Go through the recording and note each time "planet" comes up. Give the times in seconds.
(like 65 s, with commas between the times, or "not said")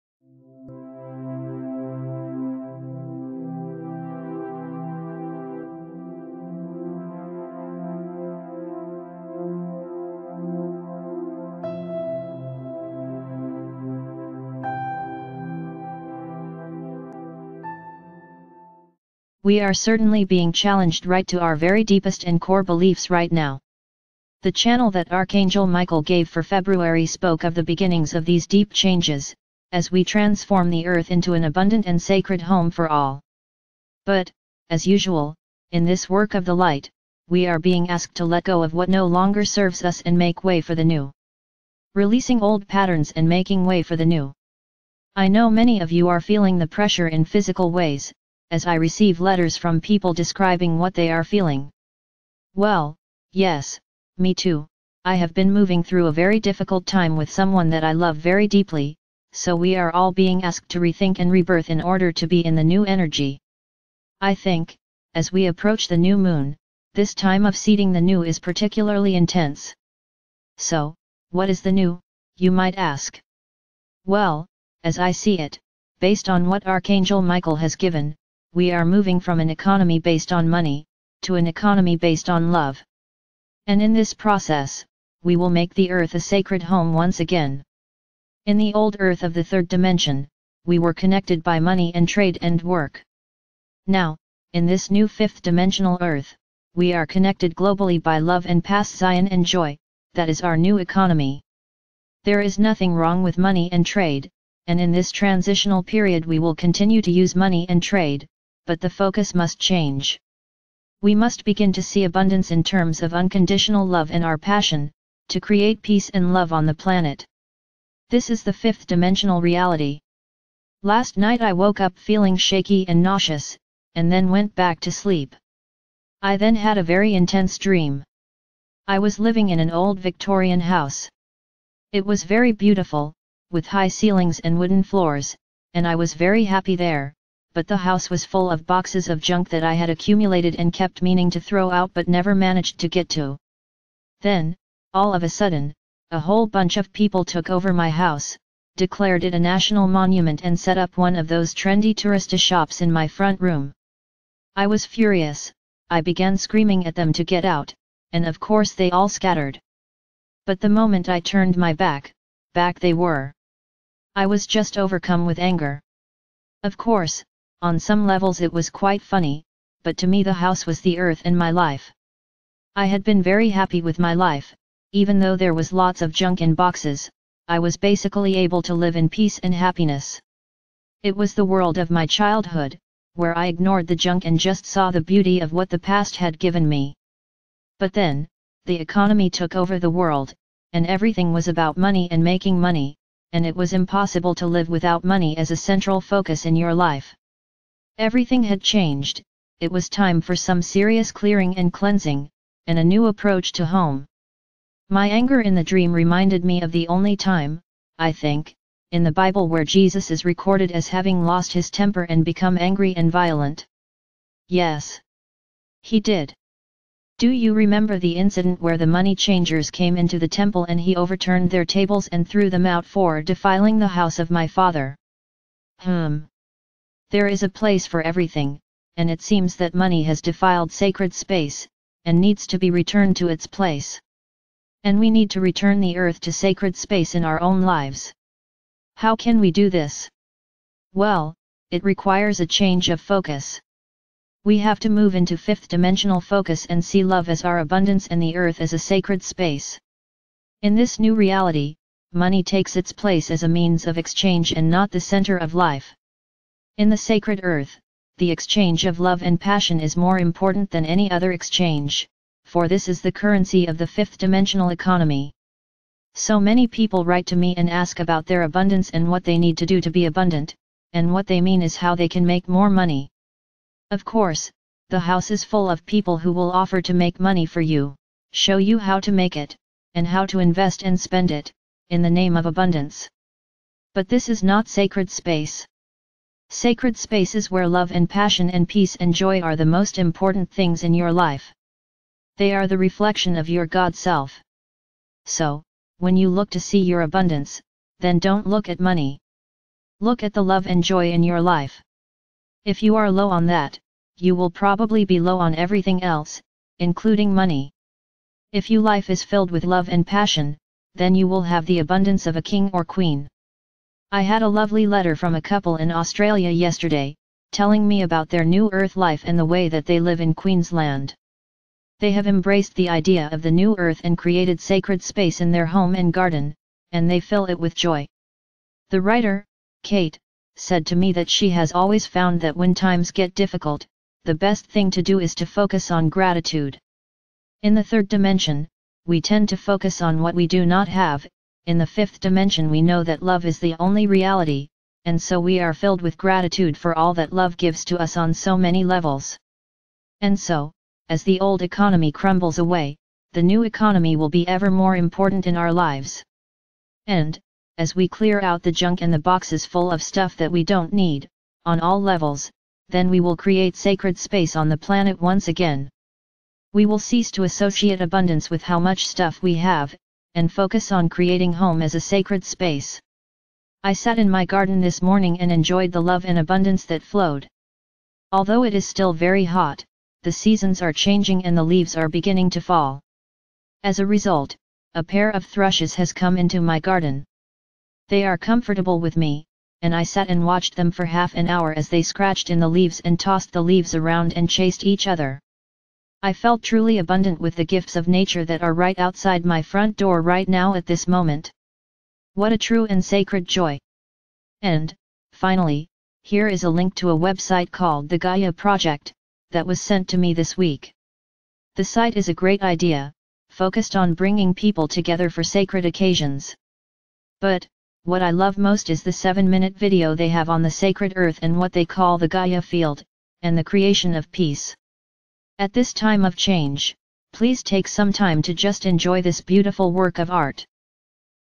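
116 s, 364 s.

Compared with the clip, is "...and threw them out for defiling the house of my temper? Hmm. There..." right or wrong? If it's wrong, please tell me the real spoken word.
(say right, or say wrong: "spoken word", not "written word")
wrong: "father", not "temper".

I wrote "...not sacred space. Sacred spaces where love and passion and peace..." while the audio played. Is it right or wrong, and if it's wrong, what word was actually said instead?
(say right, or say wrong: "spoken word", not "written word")
right.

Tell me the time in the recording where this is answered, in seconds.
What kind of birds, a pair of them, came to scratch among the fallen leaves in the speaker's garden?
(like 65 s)
385 s.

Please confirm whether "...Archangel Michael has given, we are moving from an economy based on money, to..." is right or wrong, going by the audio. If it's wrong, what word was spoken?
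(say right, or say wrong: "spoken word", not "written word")
right.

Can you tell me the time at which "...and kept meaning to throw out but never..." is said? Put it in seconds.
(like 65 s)
140 s.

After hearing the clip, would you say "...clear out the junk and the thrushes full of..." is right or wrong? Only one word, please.
wrong.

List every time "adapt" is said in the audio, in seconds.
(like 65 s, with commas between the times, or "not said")
not said.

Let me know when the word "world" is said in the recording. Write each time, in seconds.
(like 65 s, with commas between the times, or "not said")
181 s, 189 s.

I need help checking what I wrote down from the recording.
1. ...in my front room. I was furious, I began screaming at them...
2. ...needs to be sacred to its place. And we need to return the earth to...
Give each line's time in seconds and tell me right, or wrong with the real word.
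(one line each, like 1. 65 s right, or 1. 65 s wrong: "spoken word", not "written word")
1. 152 s right
2. 232 s wrong: "returned", not "sacred".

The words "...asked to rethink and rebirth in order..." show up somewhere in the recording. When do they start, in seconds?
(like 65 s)
60 s.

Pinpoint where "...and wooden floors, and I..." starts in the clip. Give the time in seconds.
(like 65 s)
134 s.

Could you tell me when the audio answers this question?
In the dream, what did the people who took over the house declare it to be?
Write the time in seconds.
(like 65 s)
149 s.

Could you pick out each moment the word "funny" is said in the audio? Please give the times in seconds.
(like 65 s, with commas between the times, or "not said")
169 s.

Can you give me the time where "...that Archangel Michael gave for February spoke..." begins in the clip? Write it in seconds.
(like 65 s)
24 s.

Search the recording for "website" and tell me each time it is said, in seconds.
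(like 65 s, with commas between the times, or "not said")
407 s.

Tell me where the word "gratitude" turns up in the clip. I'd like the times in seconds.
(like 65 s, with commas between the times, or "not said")
336 s, 346 s.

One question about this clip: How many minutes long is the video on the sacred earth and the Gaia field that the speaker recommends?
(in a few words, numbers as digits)
7.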